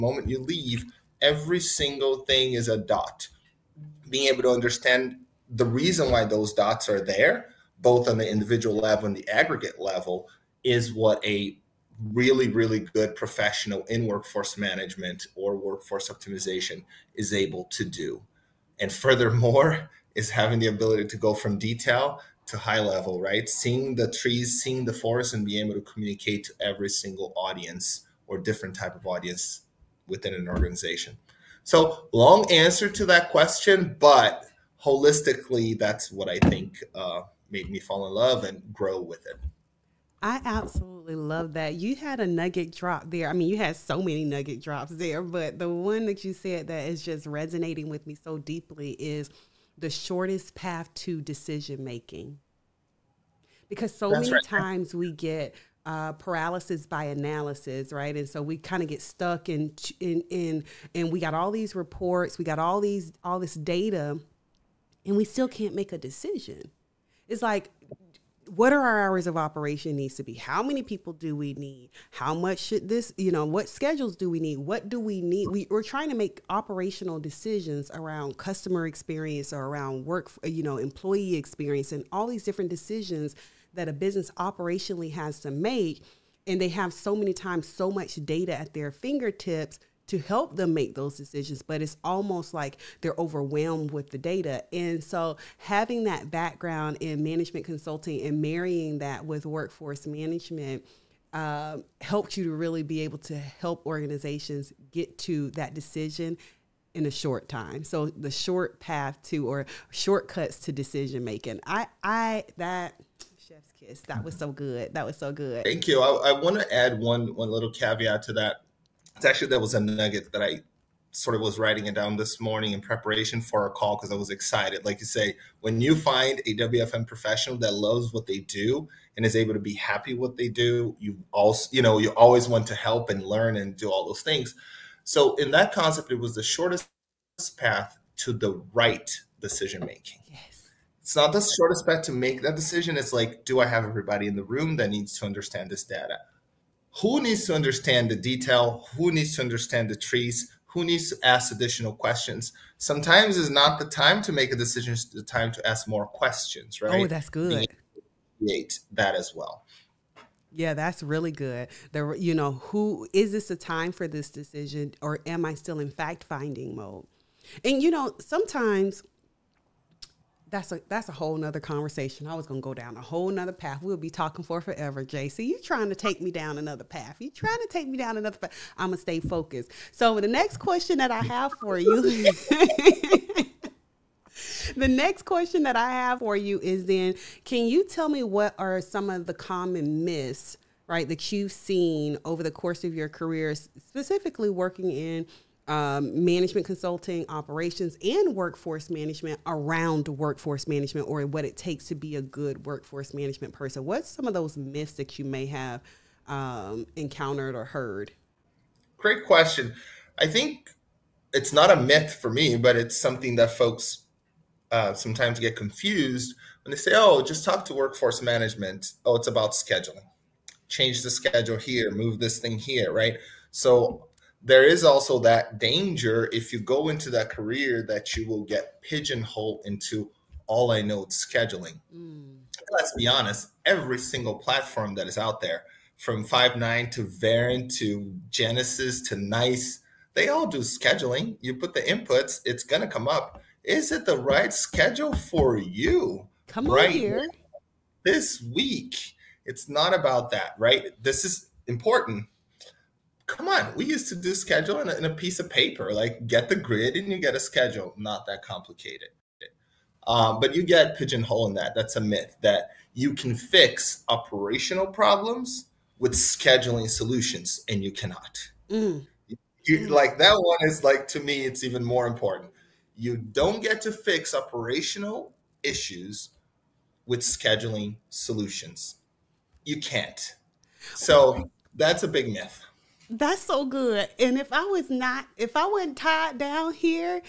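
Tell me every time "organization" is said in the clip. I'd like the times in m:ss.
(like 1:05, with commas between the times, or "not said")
0:30, 1:43.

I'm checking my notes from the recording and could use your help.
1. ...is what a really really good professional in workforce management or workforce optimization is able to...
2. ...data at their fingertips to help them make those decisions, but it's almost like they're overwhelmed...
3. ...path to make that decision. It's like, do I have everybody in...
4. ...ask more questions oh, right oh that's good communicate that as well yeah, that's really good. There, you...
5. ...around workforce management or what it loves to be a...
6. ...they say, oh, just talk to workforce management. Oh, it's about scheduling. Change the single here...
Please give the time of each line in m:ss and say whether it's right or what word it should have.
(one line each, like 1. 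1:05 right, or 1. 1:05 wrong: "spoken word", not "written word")
1. 0:10 right
2. 1:28 right
3. 2:21 right
4. 2:35 wrong: "create", not "communicate"
5. 3:19 wrong: "takes", not "loves"
6. 3:36 wrong: "schedule", not "single".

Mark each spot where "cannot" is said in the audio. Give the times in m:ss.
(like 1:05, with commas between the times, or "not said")
4:27.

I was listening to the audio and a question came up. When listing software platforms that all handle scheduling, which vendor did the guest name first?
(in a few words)
Five9.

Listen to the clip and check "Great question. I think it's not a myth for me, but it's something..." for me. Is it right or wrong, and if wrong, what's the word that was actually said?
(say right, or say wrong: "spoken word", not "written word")
right.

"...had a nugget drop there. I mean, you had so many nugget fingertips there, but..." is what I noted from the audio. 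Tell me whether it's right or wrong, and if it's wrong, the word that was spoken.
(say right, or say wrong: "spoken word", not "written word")
wrong: "drops", not "fingertips".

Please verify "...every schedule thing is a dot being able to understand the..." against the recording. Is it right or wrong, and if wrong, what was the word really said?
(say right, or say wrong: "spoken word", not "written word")
wrong: "single", not "schedule".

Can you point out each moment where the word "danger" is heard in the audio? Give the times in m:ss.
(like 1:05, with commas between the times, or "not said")
3:45.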